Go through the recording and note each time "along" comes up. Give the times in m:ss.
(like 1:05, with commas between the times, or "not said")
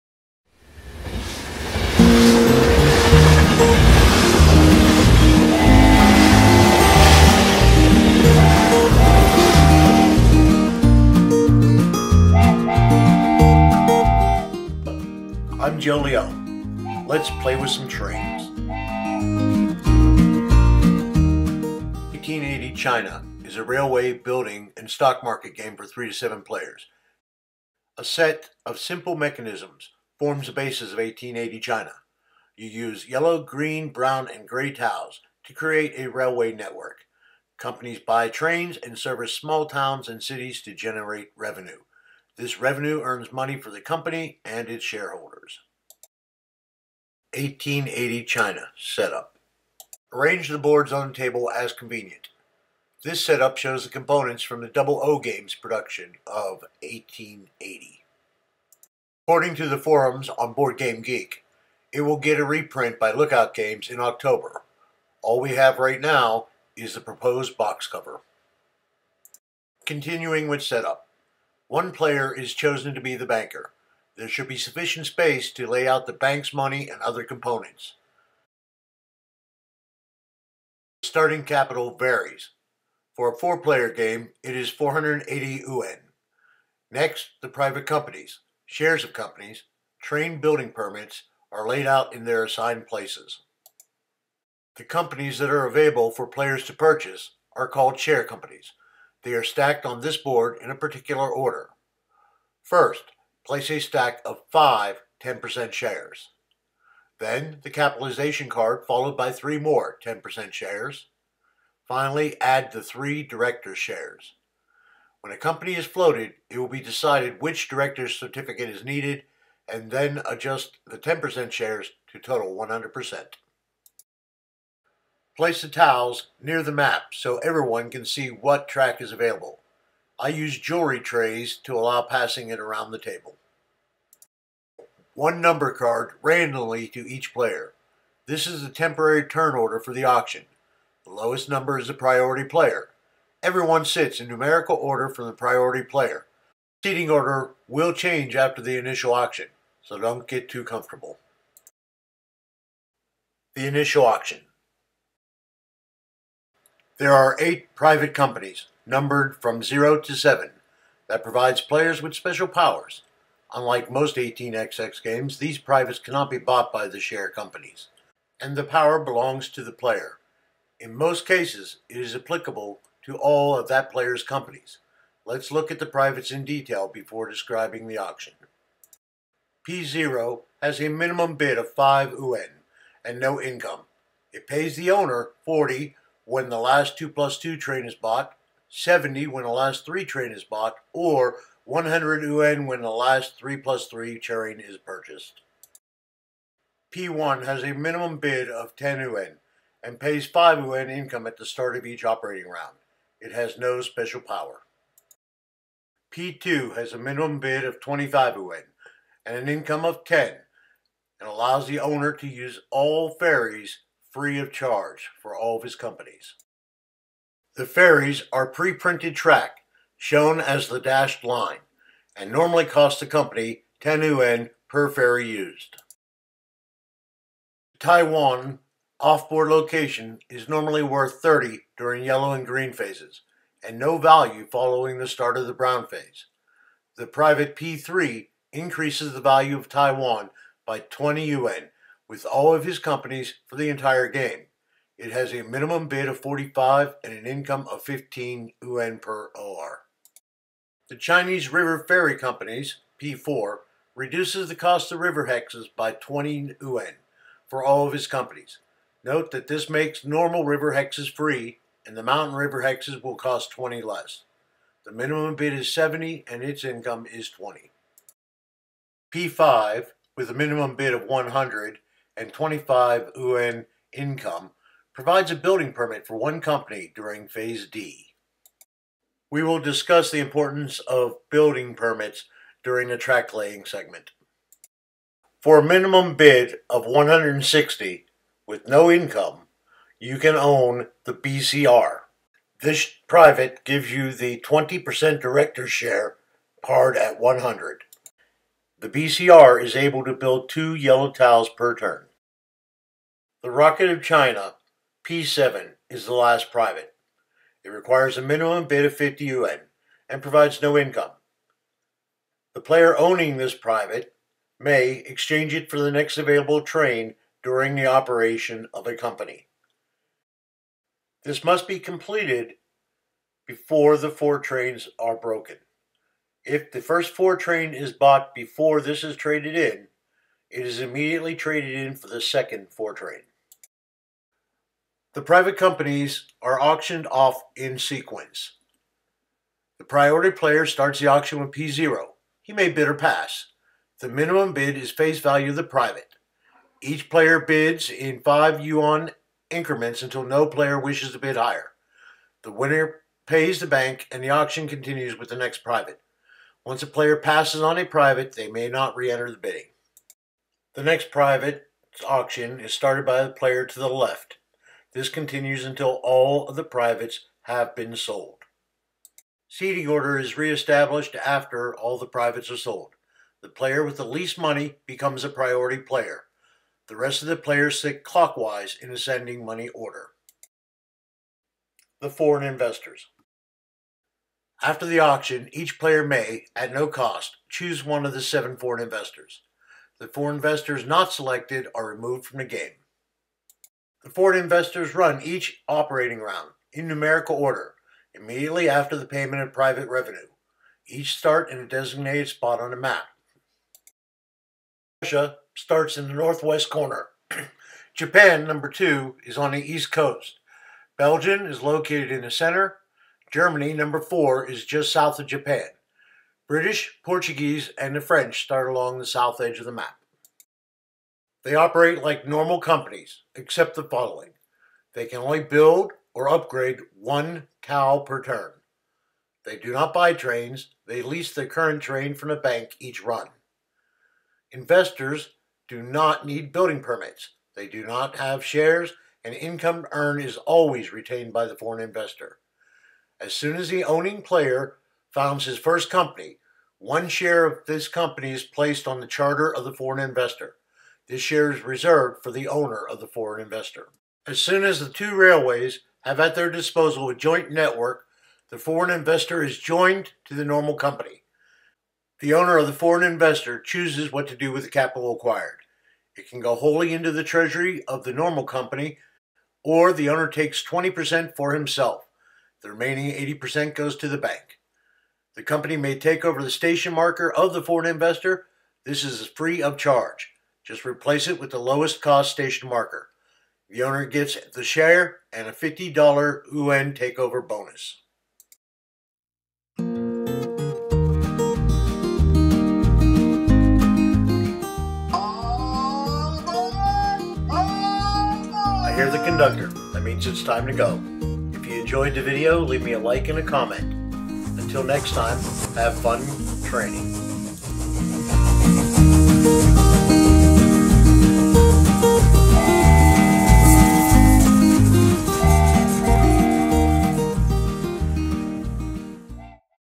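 6:58.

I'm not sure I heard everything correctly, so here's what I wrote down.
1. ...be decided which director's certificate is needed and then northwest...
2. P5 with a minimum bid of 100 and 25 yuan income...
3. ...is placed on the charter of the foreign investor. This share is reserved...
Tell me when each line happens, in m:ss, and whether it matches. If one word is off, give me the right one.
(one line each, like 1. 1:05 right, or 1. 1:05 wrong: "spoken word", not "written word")
1. 1:56 wrong: "adjust", not "northwest"
2. 4:29 right
3. 7:28 right.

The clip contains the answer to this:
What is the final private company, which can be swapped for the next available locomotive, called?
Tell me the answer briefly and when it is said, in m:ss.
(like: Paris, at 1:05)
The Rocket of China, at 5:03.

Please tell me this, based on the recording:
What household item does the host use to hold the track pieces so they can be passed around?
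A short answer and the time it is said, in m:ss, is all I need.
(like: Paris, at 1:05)
jewelry trays, at 2:10.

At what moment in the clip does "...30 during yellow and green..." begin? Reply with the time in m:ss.
3:51.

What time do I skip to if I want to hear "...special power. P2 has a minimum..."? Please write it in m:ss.
3:23.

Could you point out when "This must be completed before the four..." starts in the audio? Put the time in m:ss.
5:21.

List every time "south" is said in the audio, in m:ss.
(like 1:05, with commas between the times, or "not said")
6:54, 6:59.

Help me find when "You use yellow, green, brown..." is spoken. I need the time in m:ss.
0:32.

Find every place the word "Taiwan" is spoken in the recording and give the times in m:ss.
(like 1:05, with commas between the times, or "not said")
3:47, 3:59.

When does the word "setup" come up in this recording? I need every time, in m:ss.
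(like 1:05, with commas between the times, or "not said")
0:48, 0:53, 1:10.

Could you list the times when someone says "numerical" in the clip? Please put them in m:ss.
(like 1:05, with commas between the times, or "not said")
2:24, 6:36.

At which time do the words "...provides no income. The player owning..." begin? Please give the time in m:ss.
5:10.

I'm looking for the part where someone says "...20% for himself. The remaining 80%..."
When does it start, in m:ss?
7:50.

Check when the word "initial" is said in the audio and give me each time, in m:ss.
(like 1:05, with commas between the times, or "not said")
2:28, 2:33.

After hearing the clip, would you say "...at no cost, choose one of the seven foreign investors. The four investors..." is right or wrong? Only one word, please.
right.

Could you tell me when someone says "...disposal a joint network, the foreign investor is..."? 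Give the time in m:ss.
7:36.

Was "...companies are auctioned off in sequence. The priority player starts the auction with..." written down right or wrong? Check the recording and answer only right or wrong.
right.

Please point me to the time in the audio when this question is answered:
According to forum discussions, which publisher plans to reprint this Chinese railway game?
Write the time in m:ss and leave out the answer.
1:03.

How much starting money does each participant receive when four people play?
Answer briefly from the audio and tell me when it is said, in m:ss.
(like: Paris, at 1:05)
480 yuan, at 1:24.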